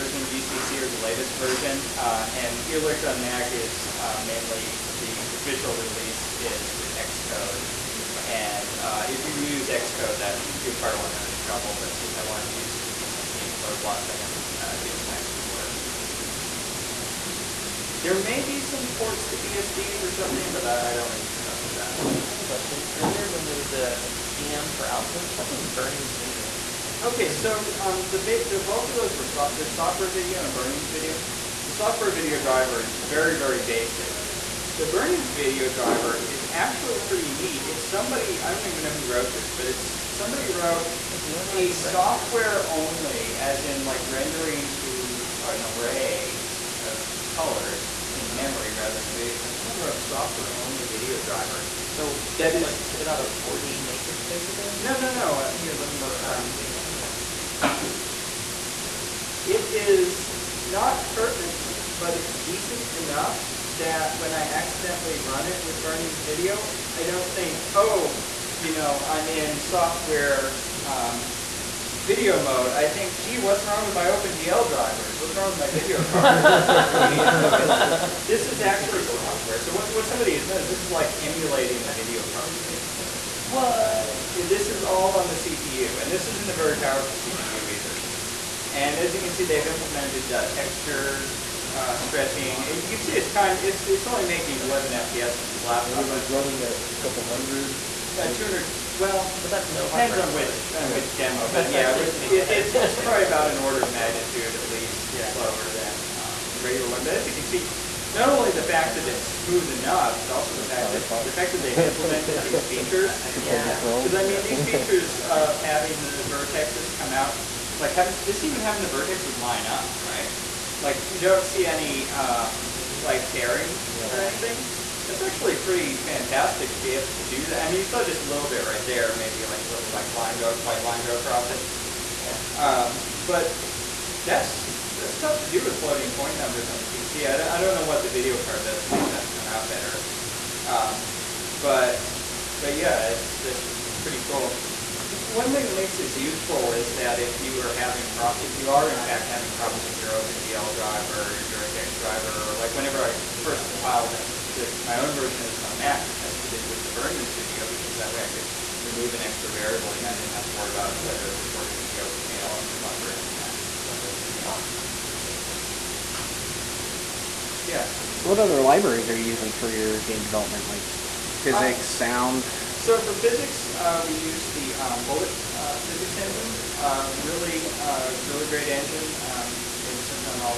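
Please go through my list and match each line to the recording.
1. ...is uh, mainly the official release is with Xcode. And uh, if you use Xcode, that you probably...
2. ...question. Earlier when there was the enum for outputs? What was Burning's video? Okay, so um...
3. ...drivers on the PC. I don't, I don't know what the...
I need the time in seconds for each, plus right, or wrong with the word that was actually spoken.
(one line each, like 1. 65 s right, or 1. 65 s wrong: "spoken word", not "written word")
1. 3 s right
2. 22 s right
3. 136 s wrong: "numbers", not "drivers".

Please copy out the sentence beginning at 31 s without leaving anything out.
The software video driver is very, very basic.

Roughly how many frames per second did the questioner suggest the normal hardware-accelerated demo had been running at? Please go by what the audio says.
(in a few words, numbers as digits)
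200.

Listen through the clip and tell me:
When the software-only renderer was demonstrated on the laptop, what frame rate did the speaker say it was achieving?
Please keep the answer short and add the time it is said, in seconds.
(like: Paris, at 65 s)
11 FPS, at 94 s.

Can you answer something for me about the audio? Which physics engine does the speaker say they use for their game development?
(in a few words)
Bullet.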